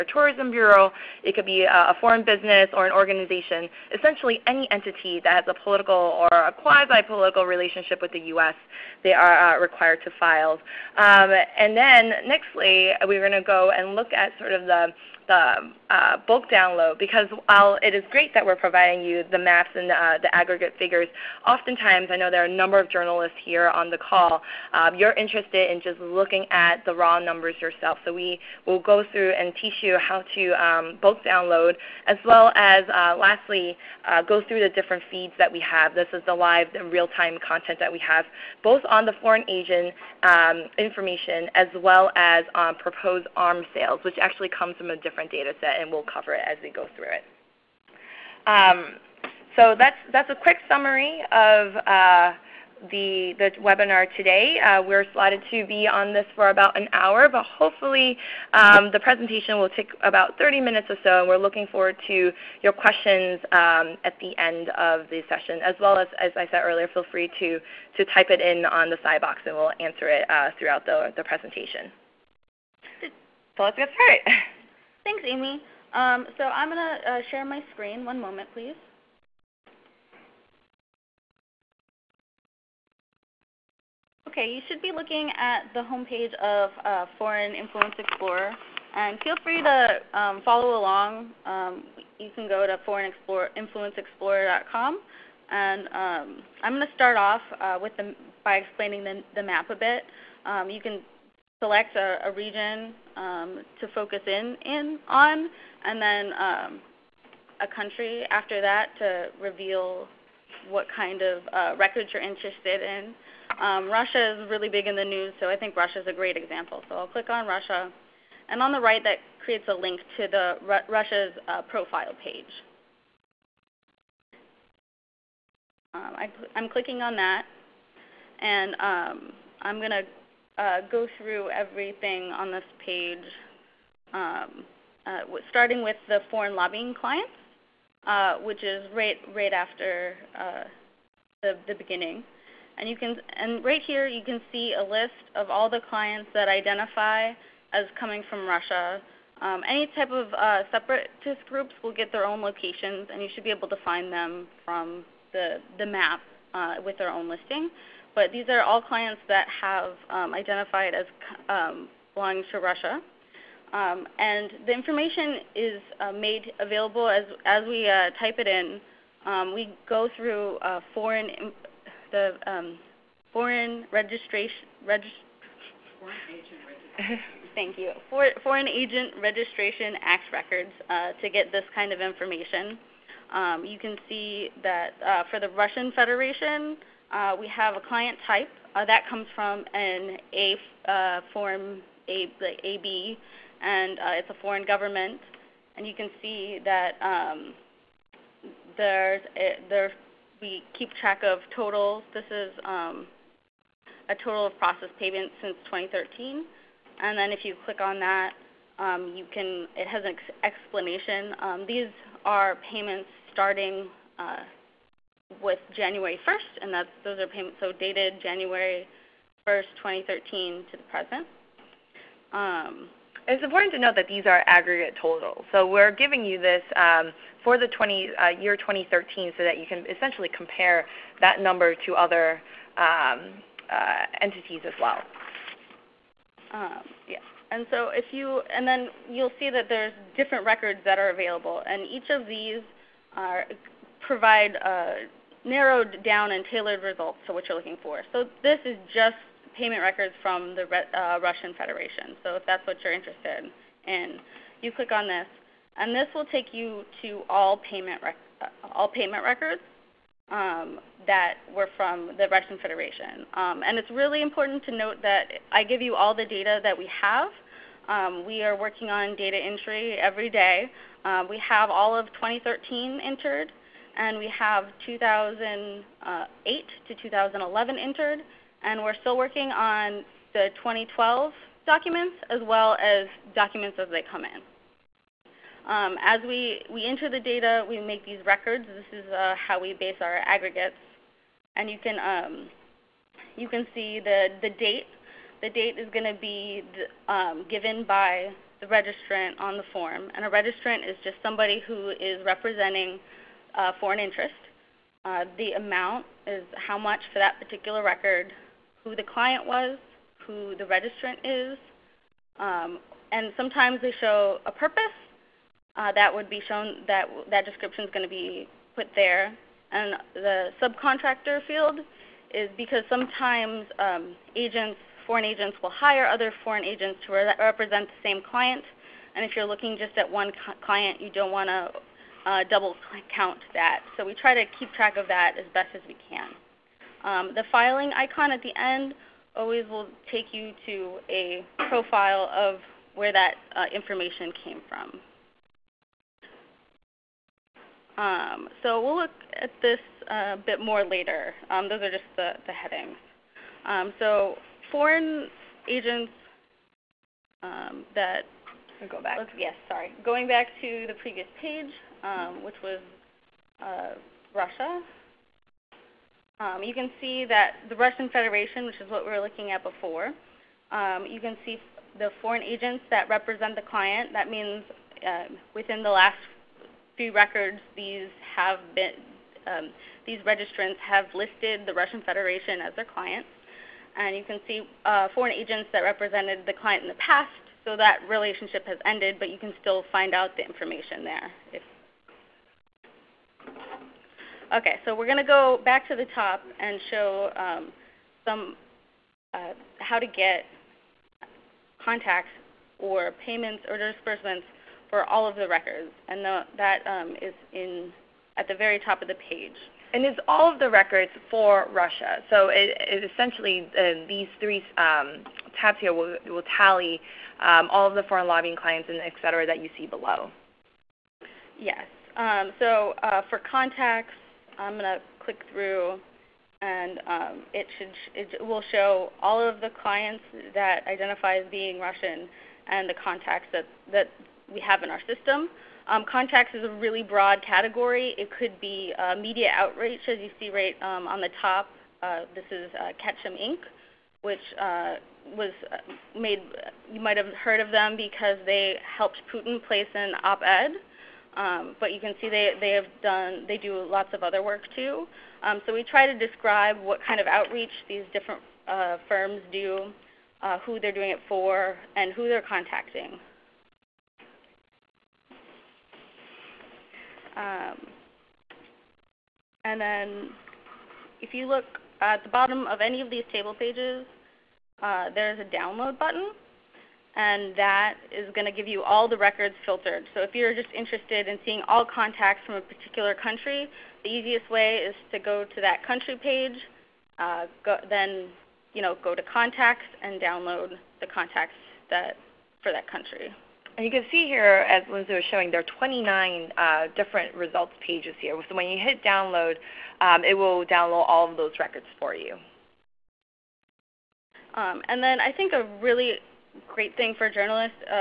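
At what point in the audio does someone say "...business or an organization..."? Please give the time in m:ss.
0:02.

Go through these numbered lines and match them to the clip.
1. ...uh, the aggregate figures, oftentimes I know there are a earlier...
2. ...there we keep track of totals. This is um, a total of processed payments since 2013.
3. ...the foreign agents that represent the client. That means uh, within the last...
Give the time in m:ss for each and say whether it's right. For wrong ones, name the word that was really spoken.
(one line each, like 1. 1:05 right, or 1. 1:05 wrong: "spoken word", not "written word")
1. 0:19 wrong: "number", not "earlier"
2. 3:19 right
3. 6:11 right.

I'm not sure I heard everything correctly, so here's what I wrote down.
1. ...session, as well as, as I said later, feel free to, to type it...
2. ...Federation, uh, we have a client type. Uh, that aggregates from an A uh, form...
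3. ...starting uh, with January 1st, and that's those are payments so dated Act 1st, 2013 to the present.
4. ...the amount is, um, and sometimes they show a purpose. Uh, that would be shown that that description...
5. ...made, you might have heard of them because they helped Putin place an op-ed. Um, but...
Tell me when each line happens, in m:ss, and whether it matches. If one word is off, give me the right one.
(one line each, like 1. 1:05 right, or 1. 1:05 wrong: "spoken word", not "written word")
1. 1:05 wrong: "earlier", not "later"
2. 3:05 wrong: "comes", not "aggregates"
3. 3:33 wrong: "January", not "Act"
4. 5:10 wrong: "registrant", not "amount"
5. 7:26 right.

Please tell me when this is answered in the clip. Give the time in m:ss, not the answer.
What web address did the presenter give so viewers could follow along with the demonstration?
1:32.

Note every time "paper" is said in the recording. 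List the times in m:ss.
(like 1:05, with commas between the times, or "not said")
not said.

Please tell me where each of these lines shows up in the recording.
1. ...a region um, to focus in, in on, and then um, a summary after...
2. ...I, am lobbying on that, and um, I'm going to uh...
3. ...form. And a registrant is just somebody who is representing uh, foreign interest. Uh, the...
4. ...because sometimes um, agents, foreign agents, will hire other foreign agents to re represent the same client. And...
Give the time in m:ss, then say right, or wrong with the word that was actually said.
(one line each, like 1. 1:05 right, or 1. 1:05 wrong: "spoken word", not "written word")
1. 1:42 wrong: "country", not "summary"
2. 2:06 wrong: "clicking", not "lobbying"
3. 4:59 right
4. 5:22 right.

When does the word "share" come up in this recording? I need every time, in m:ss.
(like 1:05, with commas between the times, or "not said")
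1:17.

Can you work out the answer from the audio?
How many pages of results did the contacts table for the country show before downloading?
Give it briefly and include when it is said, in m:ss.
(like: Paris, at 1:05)
29, at 8:15.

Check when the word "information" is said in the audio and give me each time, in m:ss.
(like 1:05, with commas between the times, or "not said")
0:40, 2:44, 3:02, 5:43, 6:30.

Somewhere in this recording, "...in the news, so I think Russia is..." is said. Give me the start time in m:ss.
1:54.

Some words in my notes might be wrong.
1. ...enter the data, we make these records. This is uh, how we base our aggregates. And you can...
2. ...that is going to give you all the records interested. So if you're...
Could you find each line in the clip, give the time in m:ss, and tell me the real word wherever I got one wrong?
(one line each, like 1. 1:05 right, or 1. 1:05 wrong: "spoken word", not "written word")
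1. 4:46 right
2. 7:57 wrong: "filtered", not "interested".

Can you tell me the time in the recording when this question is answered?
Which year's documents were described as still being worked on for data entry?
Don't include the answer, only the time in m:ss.
4:40.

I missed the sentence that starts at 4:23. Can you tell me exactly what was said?
Um, and it's really important to note that I give you all the data that we have.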